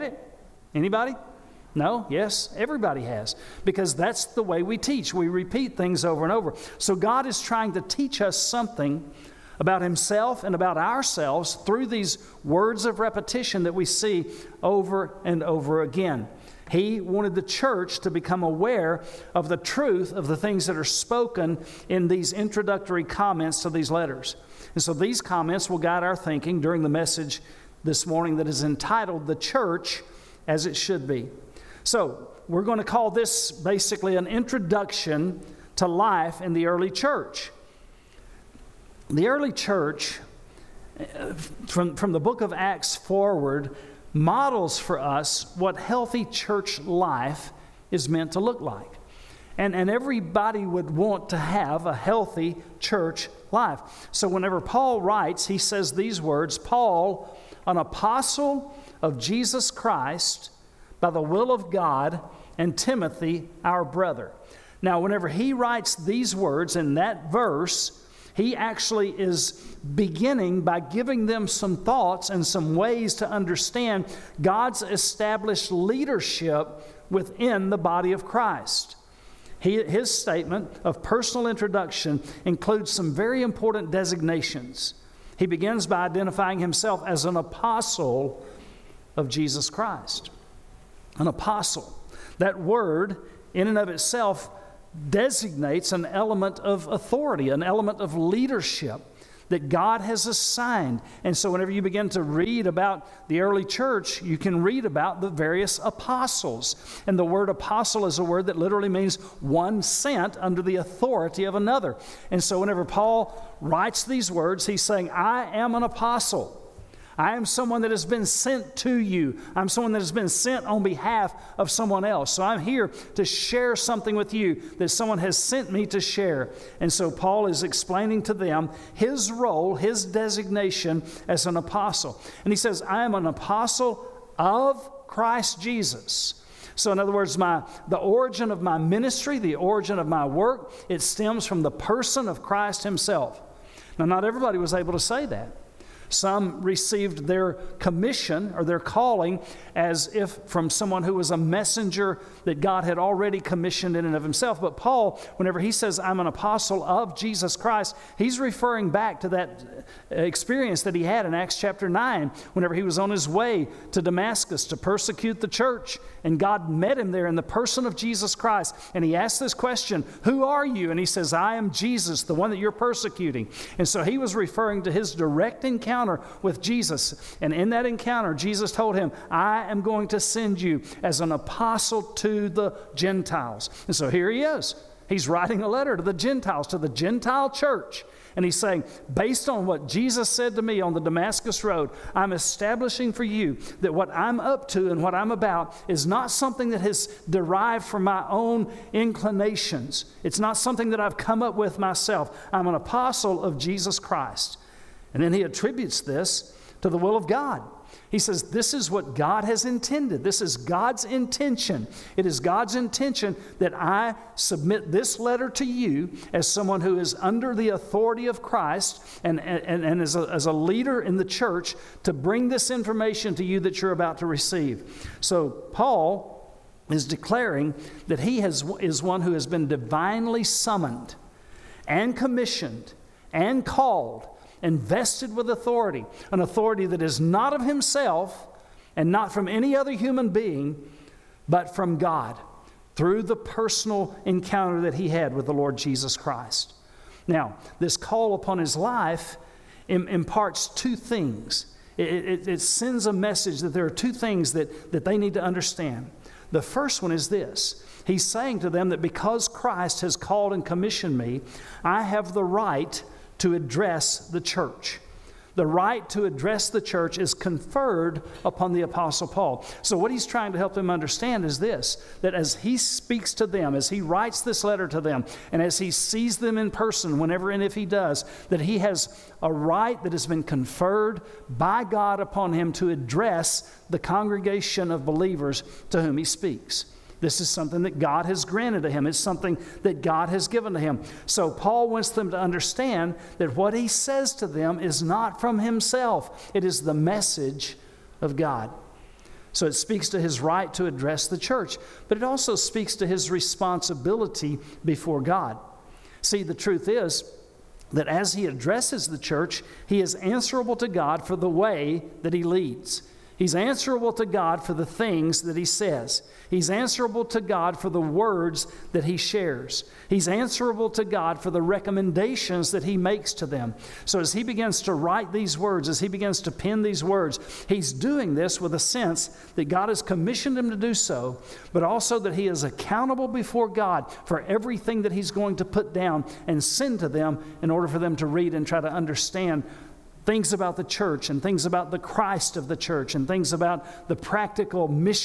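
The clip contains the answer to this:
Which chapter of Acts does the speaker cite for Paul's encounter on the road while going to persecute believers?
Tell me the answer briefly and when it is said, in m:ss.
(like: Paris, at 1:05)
Acts chapter 9, at 2:41.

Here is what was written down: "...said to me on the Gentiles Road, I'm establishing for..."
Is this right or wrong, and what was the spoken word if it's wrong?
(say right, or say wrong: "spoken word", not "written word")
wrong: "Damascus", not "Gentiles".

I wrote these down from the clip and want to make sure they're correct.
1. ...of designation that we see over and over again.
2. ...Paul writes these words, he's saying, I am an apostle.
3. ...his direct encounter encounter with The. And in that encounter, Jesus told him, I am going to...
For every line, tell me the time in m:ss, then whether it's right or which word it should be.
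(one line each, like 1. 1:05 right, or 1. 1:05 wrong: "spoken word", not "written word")
1. 0:12 wrong: "repetition", not "designation"
2. 1:52 right
3. 2:54 wrong: "Jesus", not "The".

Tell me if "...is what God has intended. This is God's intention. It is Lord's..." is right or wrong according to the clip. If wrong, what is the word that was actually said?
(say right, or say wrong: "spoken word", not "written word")
wrong: "God", not "Lord".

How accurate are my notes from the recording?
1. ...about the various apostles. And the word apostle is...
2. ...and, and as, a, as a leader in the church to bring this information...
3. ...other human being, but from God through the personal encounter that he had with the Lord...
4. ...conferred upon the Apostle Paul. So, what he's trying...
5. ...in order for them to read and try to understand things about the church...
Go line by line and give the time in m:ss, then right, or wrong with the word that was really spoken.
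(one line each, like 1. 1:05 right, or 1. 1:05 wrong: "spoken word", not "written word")
1. 1:44 right
2. 3:39 right
3. 3:59 right
4. 4:27 right
5. 5:37 right.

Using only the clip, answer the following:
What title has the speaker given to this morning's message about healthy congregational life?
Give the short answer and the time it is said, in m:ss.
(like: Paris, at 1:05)
The Church as It Should Be, at 0:29.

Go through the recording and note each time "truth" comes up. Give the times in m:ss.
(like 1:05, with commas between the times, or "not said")
0:19, 5:06.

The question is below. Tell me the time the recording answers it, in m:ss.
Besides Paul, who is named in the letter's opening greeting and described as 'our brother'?
1:02.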